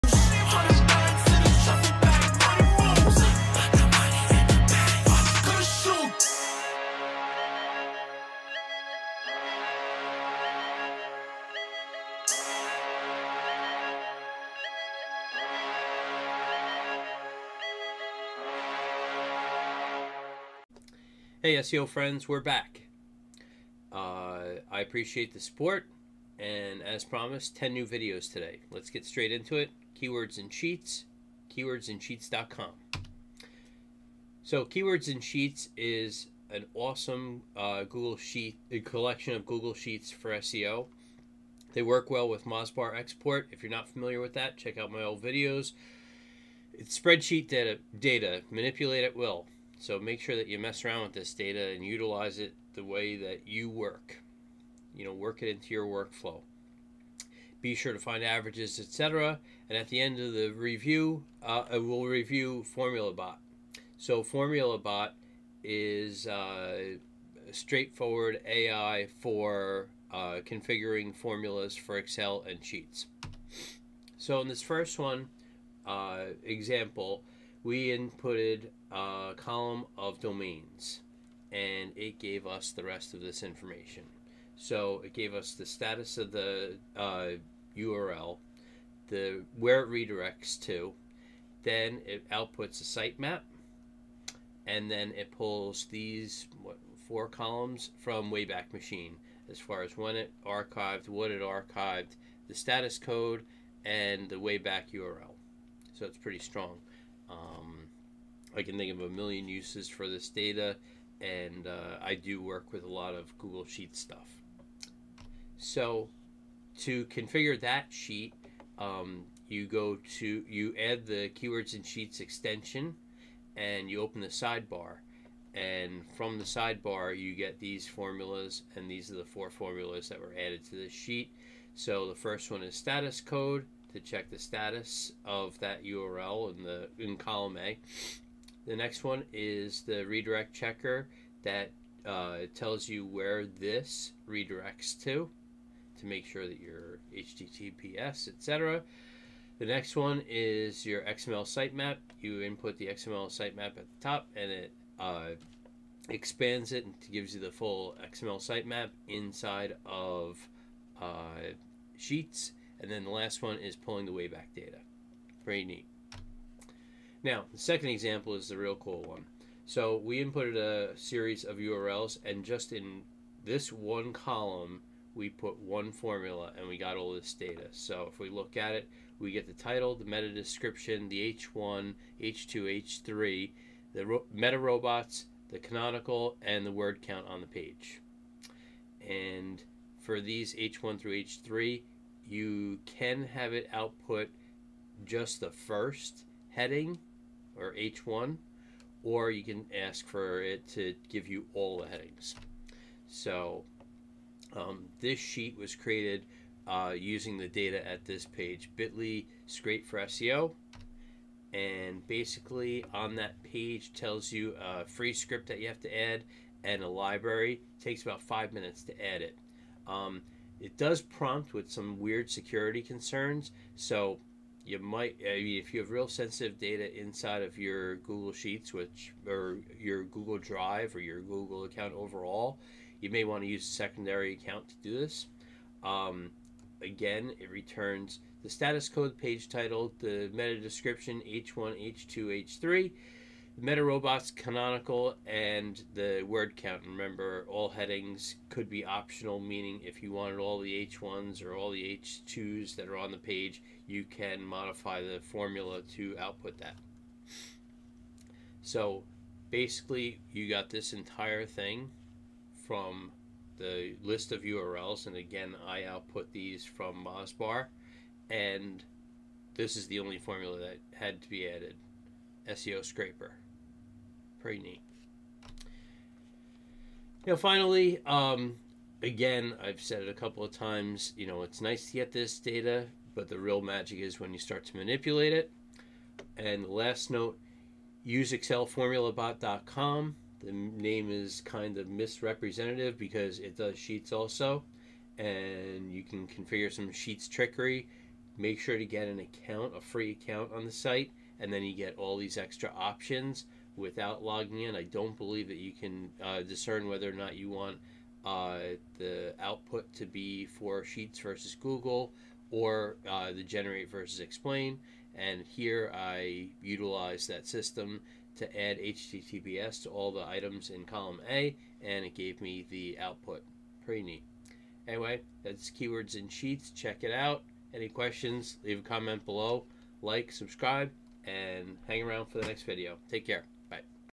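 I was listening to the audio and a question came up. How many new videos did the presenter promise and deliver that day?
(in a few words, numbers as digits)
10.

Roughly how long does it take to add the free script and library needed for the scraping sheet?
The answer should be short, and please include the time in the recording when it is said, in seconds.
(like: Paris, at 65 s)
5 minutes, at 218 s.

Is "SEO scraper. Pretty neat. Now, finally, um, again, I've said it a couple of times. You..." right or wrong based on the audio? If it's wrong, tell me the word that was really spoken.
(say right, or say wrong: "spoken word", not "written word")
right.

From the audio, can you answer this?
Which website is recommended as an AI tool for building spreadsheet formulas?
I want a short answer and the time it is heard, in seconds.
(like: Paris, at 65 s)
excelformulabot.com, at 288 s.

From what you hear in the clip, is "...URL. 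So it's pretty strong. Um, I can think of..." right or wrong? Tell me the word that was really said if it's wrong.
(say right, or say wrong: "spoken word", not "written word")
right.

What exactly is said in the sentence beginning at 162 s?
And then the last one is pulling the Wayback data.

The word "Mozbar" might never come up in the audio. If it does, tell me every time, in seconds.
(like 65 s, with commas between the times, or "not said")
42 s, 267 s.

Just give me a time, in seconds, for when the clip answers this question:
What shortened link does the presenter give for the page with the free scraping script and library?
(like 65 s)
208 s.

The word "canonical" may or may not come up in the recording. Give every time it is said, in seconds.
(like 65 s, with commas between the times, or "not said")
185 s, 244 s.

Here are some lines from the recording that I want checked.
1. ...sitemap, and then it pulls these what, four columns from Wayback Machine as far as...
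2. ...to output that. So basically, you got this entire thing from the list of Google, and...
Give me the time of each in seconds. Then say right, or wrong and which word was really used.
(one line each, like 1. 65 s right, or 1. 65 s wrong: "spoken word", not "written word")
1. 92 s right
2. 255 s wrong: "URLs", not "Google".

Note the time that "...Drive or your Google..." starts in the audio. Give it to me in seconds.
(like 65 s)
230 s.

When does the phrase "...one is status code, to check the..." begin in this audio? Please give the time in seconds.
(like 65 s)
132 s.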